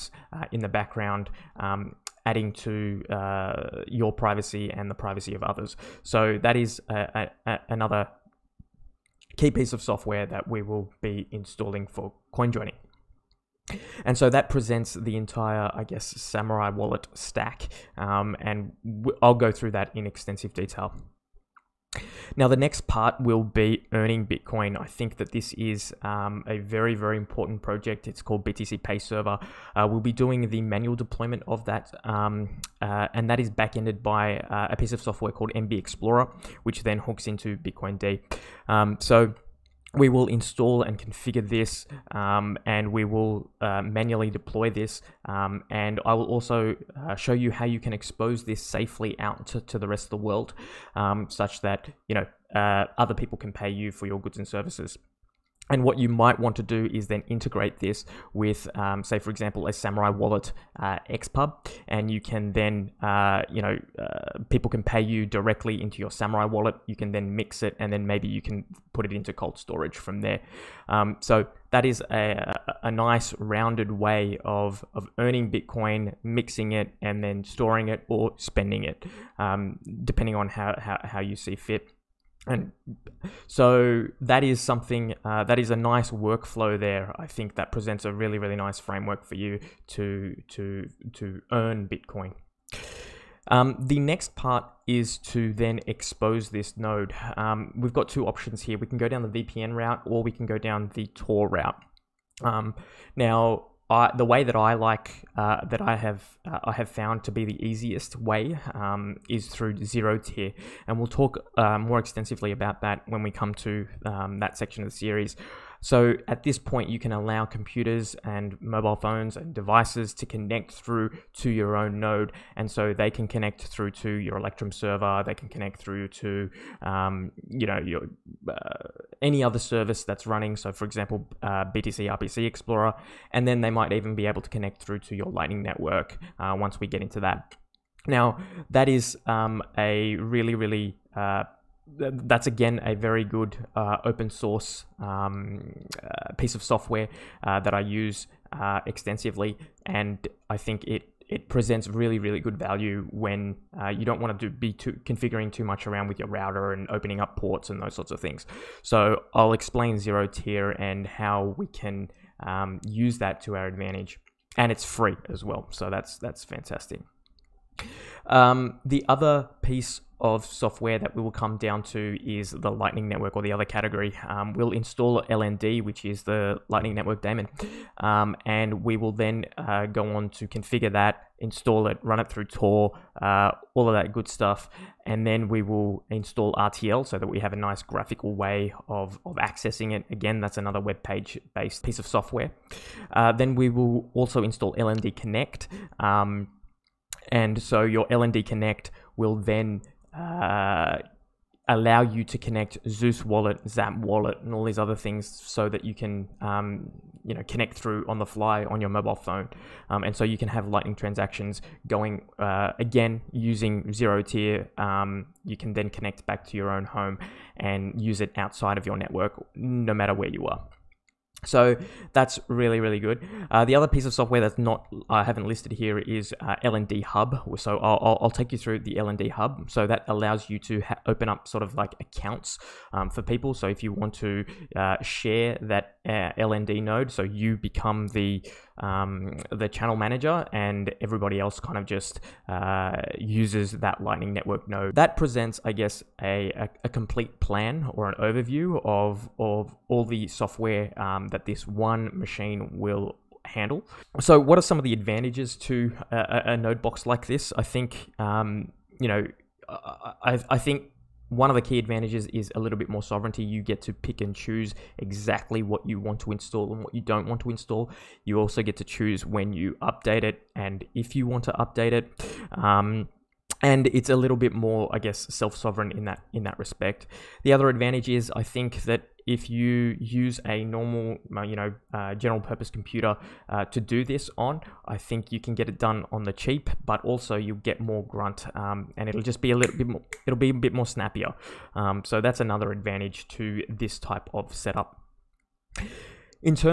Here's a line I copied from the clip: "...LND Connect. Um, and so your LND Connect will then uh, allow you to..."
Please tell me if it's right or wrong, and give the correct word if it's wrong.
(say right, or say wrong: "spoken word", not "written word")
right.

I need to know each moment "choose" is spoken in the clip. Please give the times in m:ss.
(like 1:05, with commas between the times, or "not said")
4:24, 4:28.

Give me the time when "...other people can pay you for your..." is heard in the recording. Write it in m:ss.
0:52.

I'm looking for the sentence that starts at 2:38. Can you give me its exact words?
So I'll explain ZeroTier and how we can um, use that to our advantage, and it's free as well.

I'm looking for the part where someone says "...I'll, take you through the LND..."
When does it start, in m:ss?
3:48.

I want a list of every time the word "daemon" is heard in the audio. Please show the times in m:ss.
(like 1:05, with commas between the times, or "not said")
2:57.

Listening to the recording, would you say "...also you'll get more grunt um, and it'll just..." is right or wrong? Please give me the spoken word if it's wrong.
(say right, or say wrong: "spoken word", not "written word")
right.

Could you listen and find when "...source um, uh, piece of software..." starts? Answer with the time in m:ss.
2:24.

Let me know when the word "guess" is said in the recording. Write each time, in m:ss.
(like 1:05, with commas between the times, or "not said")
0:15, 4:05, 4:34.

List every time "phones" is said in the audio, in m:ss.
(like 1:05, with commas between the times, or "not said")
1:58, 3:29.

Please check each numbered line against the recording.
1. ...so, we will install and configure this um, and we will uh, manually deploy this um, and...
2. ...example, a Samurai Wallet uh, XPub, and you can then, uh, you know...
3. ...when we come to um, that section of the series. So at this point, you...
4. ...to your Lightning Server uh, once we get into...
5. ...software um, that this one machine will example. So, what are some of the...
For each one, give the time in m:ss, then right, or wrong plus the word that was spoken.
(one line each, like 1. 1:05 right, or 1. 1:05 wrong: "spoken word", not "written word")
1. 0:38 right
2. 0:59 right
3. 1:53 right
4. 2:14 wrong: "Network", not "Server"
5. 4:10 wrong: "handle", not "example".